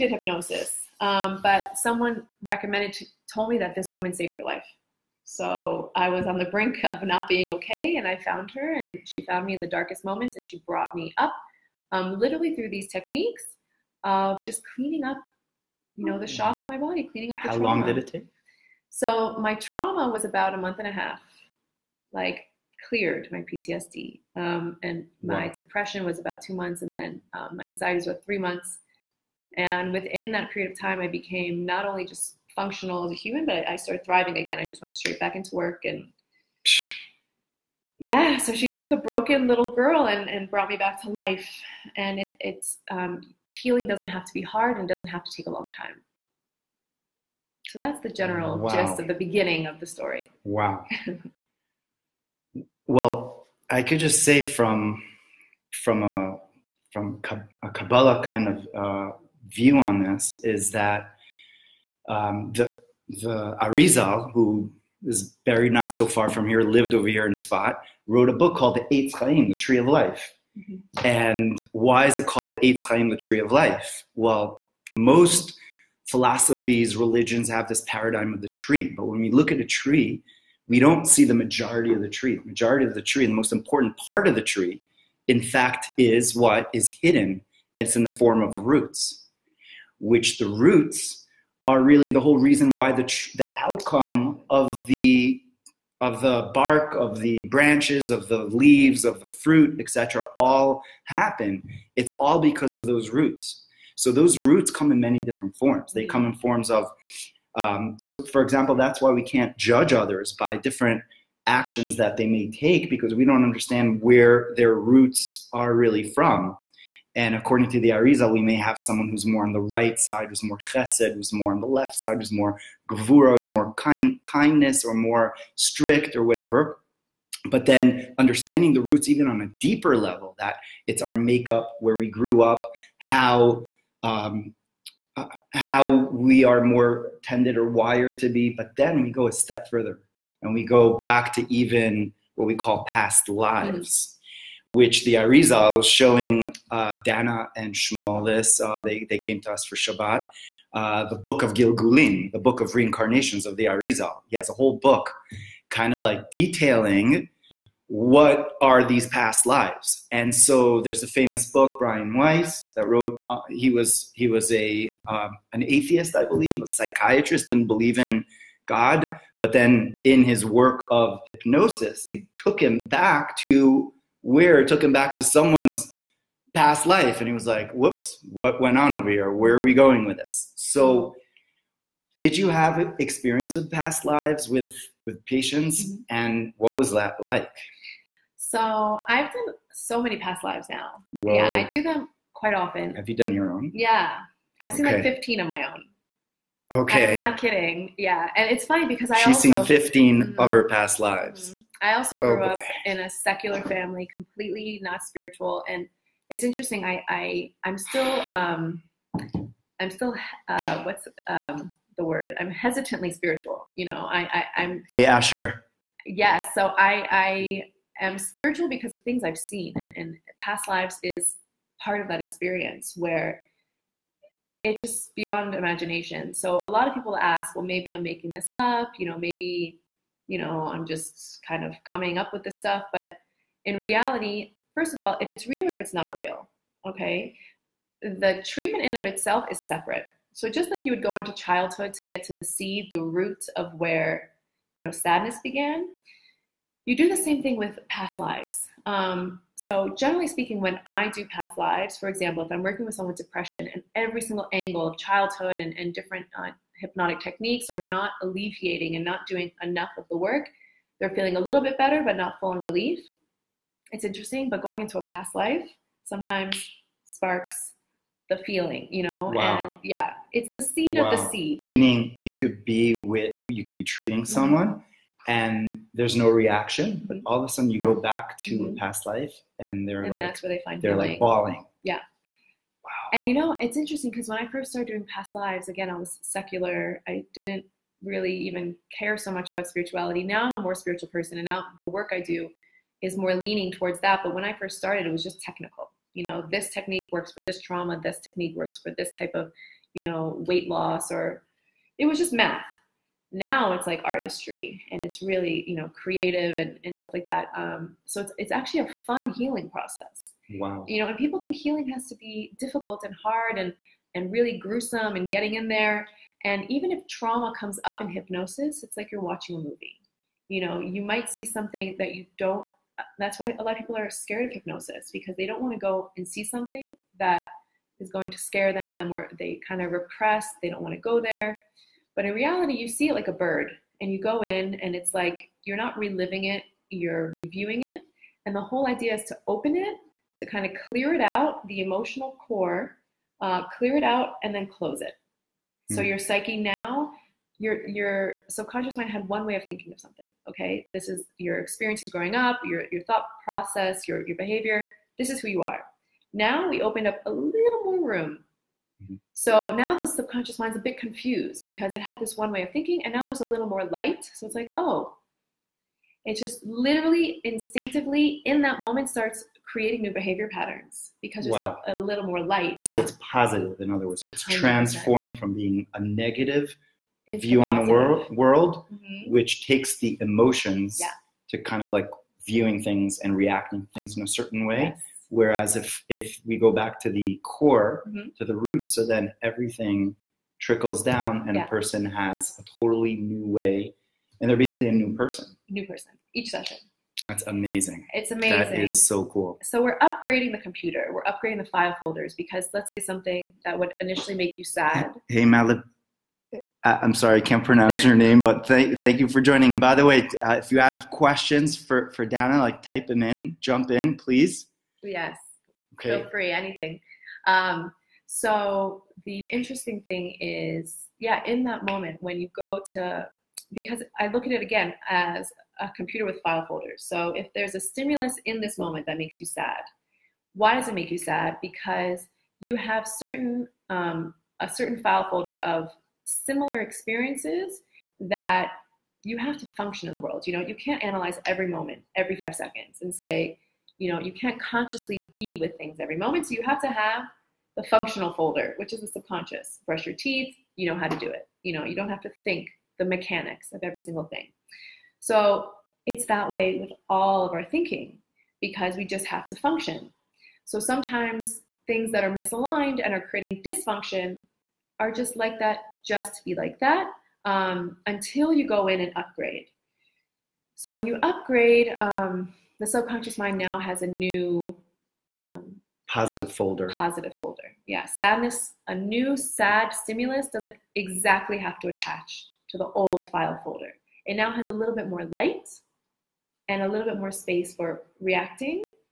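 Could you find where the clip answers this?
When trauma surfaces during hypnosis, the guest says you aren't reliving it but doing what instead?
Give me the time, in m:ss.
5:37.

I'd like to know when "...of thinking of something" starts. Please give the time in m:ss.
5:49.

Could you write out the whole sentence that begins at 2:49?
But then in his work of hypnosis, it took him back to it took him back to someone's past life.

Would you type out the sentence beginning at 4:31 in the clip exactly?
Meaning you could be with, you could be treating mm-hmm.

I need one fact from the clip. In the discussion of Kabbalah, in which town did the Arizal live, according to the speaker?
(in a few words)
Sfat.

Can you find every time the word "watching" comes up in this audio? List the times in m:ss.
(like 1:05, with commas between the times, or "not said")
5:19.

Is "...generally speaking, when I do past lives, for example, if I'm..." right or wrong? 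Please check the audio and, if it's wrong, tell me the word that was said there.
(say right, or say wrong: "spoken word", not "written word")
right.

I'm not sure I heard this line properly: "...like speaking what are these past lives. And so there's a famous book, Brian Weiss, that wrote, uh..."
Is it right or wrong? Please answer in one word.
wrong.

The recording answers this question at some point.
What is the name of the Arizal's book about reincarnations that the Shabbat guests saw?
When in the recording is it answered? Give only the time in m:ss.
2:31.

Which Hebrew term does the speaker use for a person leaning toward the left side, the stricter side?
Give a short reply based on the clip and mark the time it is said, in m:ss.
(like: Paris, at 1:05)
Gvura, at 2:02.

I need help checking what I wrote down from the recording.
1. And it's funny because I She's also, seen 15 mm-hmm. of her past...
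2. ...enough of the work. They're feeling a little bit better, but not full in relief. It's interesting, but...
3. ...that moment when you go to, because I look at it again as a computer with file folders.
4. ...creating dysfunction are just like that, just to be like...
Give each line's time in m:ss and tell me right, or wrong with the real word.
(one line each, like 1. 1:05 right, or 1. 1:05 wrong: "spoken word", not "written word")
1. 3:18 right
2. 4:19 right
3. 7:01 right
4. 7:43 right.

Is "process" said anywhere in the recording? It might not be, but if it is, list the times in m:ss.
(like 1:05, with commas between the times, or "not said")
5:09, 5:53.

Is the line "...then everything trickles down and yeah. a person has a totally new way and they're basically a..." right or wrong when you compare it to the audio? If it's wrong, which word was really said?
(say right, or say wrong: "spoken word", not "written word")
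right.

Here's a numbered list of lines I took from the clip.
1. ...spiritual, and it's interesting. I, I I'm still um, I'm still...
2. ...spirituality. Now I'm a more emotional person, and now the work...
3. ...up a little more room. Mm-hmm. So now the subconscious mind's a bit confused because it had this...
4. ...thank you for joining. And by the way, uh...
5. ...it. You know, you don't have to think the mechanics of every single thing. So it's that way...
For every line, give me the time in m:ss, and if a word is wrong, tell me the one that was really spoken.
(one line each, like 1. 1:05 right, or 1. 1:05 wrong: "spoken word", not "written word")
1. 3:25 right
2. 4:49 wrong: "spiritual", not "emotional"
3. 5:57 right
4. 6:48 right
5. 7:31 right.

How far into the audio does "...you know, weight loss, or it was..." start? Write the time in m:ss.
4:59.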